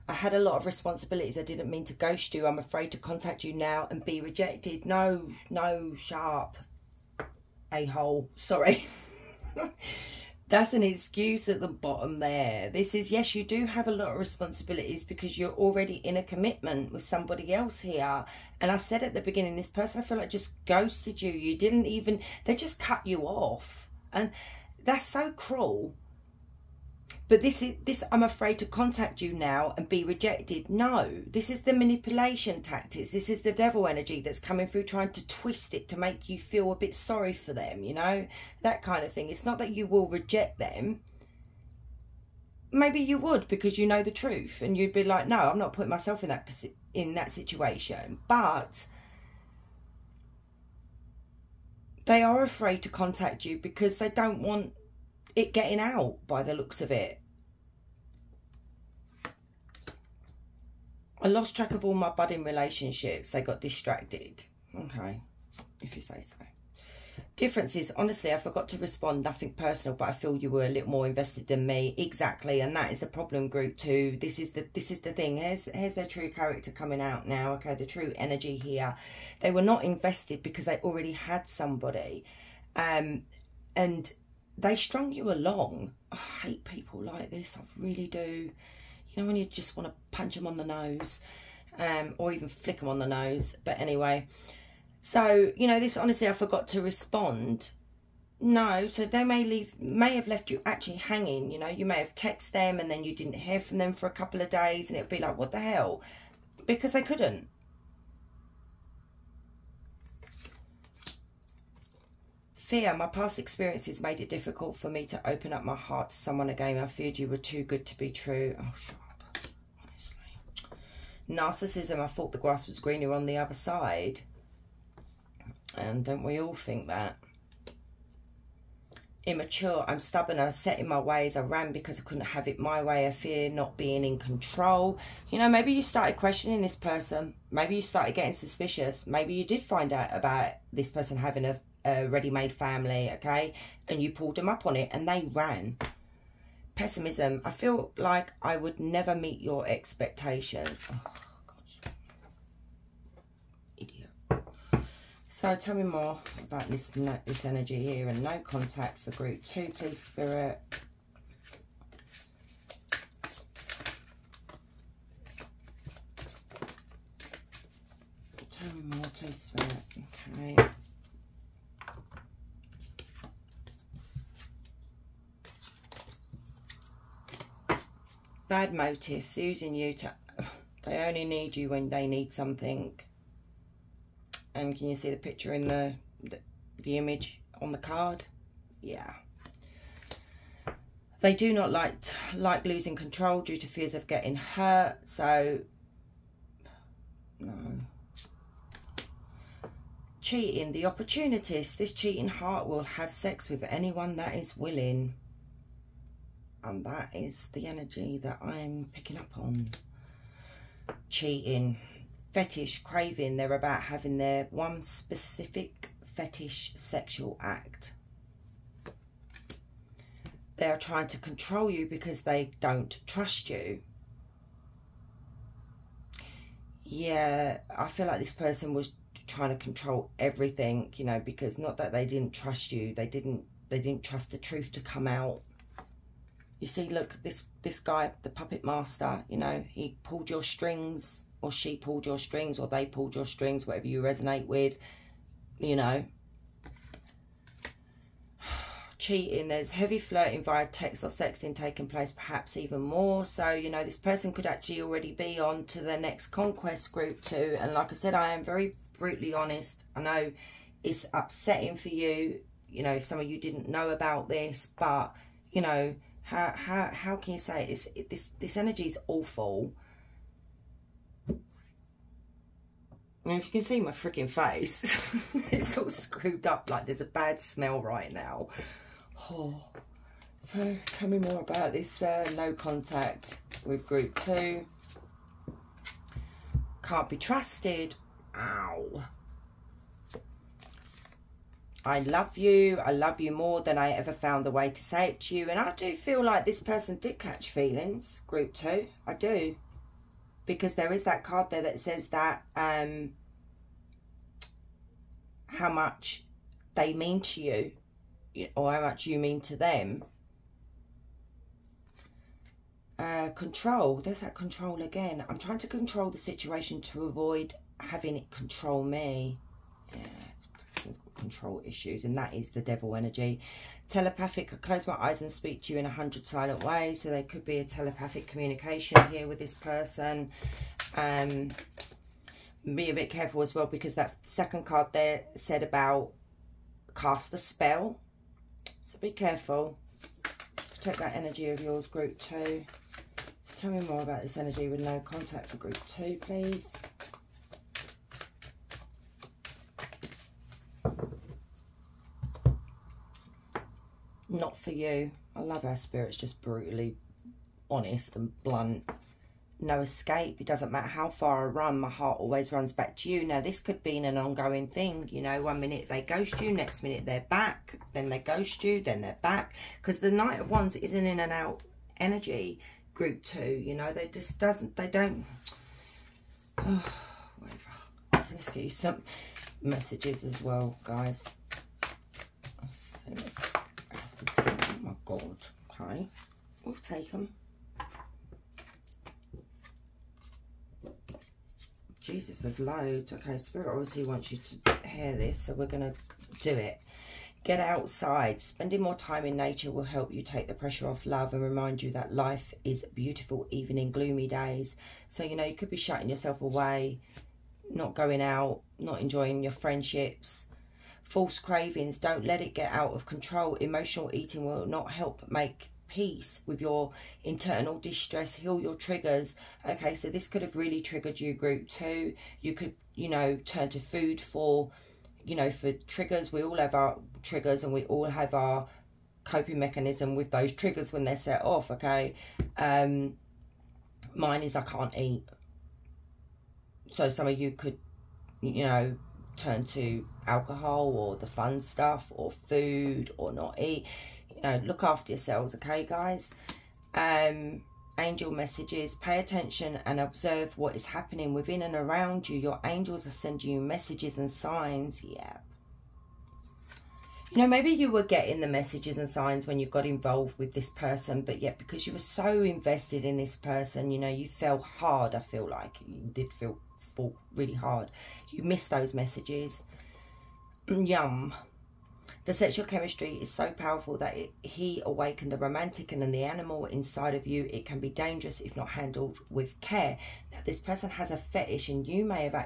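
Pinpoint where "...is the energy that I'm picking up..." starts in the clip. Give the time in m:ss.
3:27.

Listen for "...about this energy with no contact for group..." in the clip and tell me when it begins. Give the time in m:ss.
5:44.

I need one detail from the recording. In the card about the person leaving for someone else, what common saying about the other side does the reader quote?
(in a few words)
grass was greener.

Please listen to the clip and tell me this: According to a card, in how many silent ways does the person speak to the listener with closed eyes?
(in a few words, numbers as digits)
100.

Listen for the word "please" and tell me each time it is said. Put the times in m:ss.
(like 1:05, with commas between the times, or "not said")
2:39, 2:49, 5:46.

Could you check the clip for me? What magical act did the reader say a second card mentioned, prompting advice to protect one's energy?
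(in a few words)
cast a spell.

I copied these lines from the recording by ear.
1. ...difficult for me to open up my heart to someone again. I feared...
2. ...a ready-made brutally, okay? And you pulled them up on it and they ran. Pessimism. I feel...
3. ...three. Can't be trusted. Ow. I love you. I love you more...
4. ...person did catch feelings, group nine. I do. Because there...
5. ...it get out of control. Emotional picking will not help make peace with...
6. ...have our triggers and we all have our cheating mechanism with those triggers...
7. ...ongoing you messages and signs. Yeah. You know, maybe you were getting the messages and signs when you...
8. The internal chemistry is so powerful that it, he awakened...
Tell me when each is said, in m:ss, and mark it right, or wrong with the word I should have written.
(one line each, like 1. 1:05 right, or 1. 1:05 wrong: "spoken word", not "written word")
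1. 1:54 right
2. 2:21 wrong: "family", not "brutally"
3. 4:44 wrong: "two", not "three"
4. 4:56 wrong: "two", not "nine"
5. 6:52 wrong: "eating", not "picking"
6. 7:06 wrong: "coping", not "cheating"
7. 7:33 wrong: "sending", not "ongoing"
8. 7:52 wrong: "sexual", not "internal".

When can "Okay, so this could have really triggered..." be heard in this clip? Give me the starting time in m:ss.
6:59.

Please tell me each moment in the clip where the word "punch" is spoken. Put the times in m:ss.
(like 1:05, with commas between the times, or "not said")
1:30.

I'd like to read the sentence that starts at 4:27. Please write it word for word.
it's it, this this energy is awful?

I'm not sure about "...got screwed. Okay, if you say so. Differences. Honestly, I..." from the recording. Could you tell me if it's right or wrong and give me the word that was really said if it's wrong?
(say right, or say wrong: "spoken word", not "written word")
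wrong: "distracted", not "screwed".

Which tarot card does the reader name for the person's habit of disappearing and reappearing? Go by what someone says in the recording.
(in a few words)
Knight of Wands.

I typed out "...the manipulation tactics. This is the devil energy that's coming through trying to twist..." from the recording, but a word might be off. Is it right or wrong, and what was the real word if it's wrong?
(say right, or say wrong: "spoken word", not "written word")
right.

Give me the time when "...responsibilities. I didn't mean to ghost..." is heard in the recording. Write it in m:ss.
0:00.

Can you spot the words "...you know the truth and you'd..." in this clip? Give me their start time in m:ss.
0:43.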